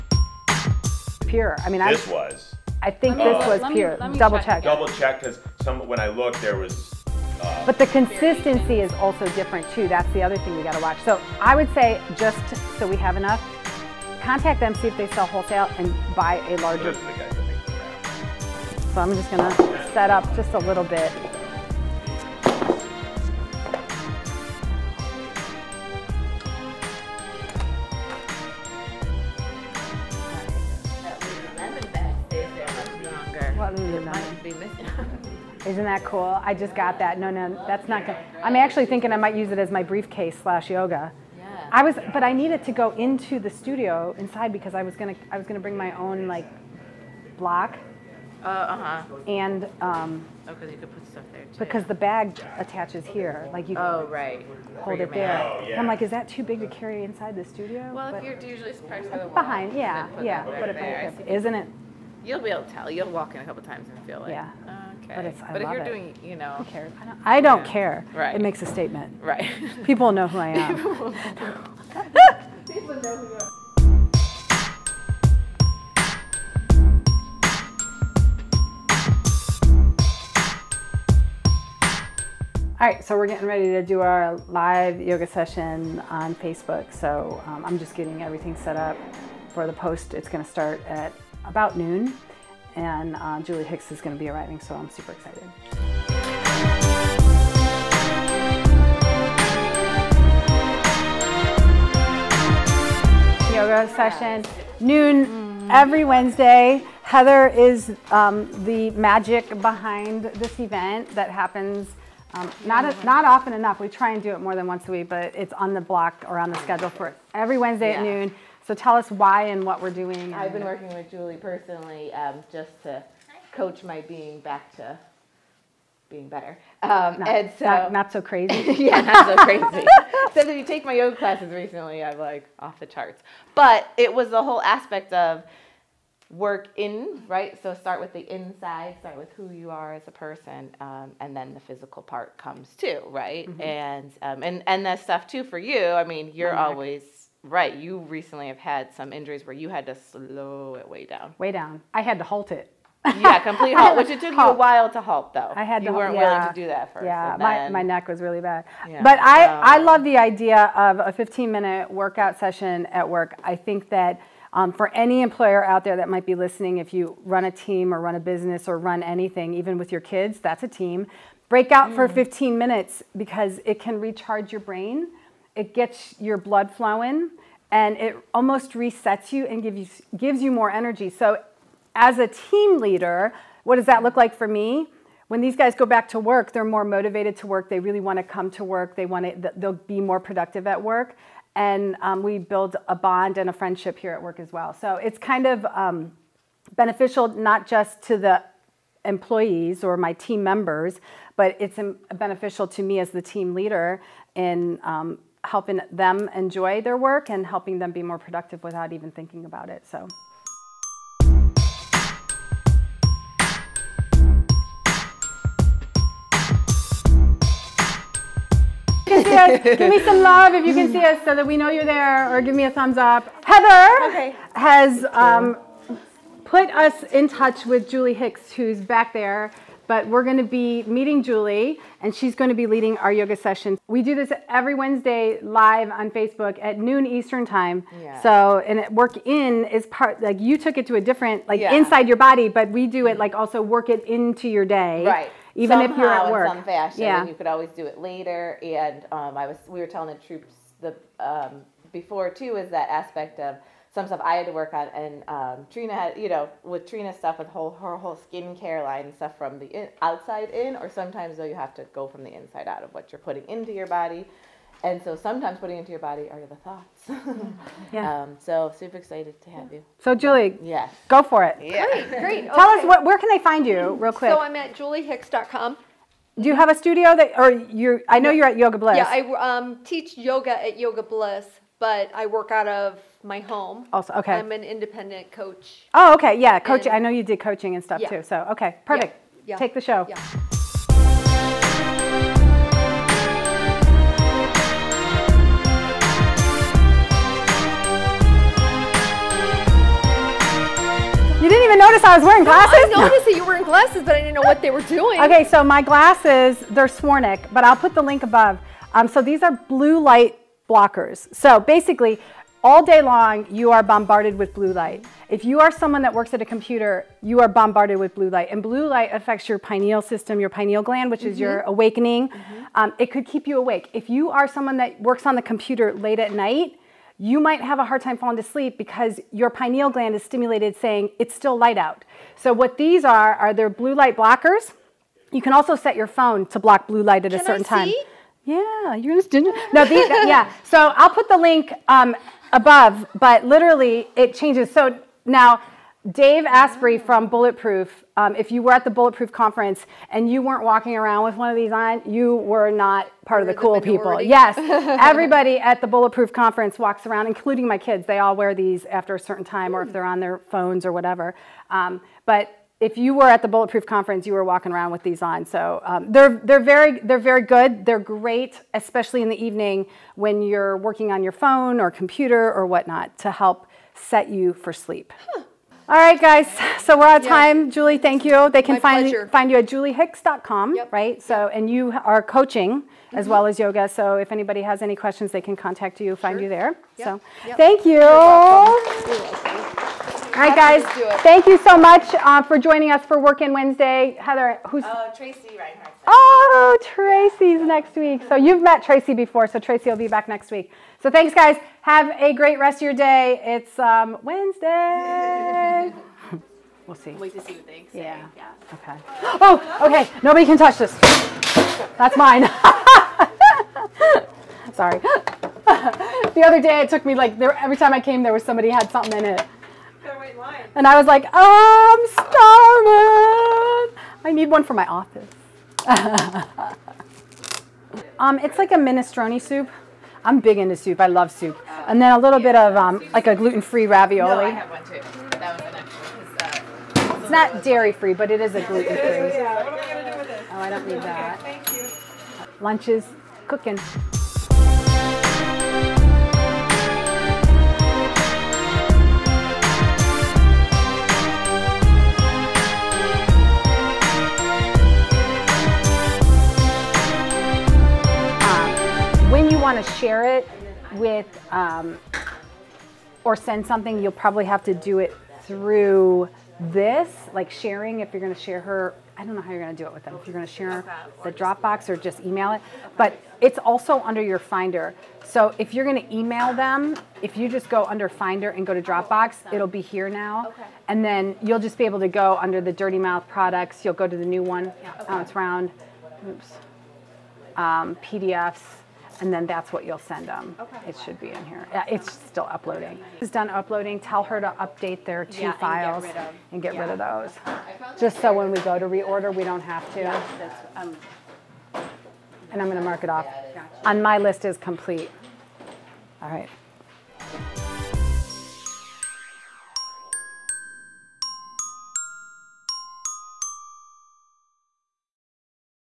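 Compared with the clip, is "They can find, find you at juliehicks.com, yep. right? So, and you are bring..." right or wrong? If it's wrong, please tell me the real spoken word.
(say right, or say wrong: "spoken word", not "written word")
wrong: "coaching", not "bring".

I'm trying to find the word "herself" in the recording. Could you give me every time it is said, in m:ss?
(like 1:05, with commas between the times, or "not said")
not said.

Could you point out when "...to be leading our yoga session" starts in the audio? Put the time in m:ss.
3:52.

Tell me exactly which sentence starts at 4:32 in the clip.
us what, where can they find you, real quick.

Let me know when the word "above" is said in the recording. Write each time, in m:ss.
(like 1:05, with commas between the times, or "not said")
5:08, 5:42.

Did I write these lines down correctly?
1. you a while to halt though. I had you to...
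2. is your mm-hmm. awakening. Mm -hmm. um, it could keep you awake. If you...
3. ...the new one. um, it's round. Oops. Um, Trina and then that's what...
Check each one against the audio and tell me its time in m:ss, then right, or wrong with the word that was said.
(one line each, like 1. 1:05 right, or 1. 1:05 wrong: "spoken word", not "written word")
1. 2:34 right
2. 5:21 right
3. 8:04 wrong: "PDFs", not "Trina".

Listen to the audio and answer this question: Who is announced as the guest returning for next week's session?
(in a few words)
Tracy Reinhardt.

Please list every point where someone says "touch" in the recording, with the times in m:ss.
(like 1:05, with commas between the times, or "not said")
3:47, 6:50.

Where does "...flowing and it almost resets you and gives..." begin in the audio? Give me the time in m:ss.
2:56.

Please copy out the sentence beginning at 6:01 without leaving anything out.
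Um, but if you were at the Bulletproof Conference, you were walking around with these on.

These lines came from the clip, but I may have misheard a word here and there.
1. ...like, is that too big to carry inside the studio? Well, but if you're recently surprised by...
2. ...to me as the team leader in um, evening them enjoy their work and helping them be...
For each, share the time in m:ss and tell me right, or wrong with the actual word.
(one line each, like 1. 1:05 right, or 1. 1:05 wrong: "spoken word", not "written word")
1. 0:55 wrong: "usually", not "recently"
2. 3:22 wrong: "helping", not "evening".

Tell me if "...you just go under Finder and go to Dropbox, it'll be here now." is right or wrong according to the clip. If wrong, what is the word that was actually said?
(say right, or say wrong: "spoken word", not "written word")
right.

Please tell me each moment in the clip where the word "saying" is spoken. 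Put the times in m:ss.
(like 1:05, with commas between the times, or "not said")
5:30.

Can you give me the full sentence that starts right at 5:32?
So what these are are they're blue light blockers.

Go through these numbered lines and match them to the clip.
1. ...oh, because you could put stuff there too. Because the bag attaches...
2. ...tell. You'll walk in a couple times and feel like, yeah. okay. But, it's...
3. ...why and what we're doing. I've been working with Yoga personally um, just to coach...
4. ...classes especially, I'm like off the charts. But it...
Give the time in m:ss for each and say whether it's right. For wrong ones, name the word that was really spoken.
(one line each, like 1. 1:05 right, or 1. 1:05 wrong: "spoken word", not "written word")
1. 0:50 right
2. 1:02 right
3. 1:59 wrong: "Julie", not "Yoga"
4. 2:11 wrong: "recently", not "especially".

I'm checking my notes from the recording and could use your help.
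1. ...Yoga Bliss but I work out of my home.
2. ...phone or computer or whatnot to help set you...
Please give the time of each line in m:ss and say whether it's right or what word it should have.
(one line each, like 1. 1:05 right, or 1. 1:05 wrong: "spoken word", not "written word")
1. 4:40 right
2. 6:11 right.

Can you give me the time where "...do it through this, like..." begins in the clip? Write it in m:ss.
7:44.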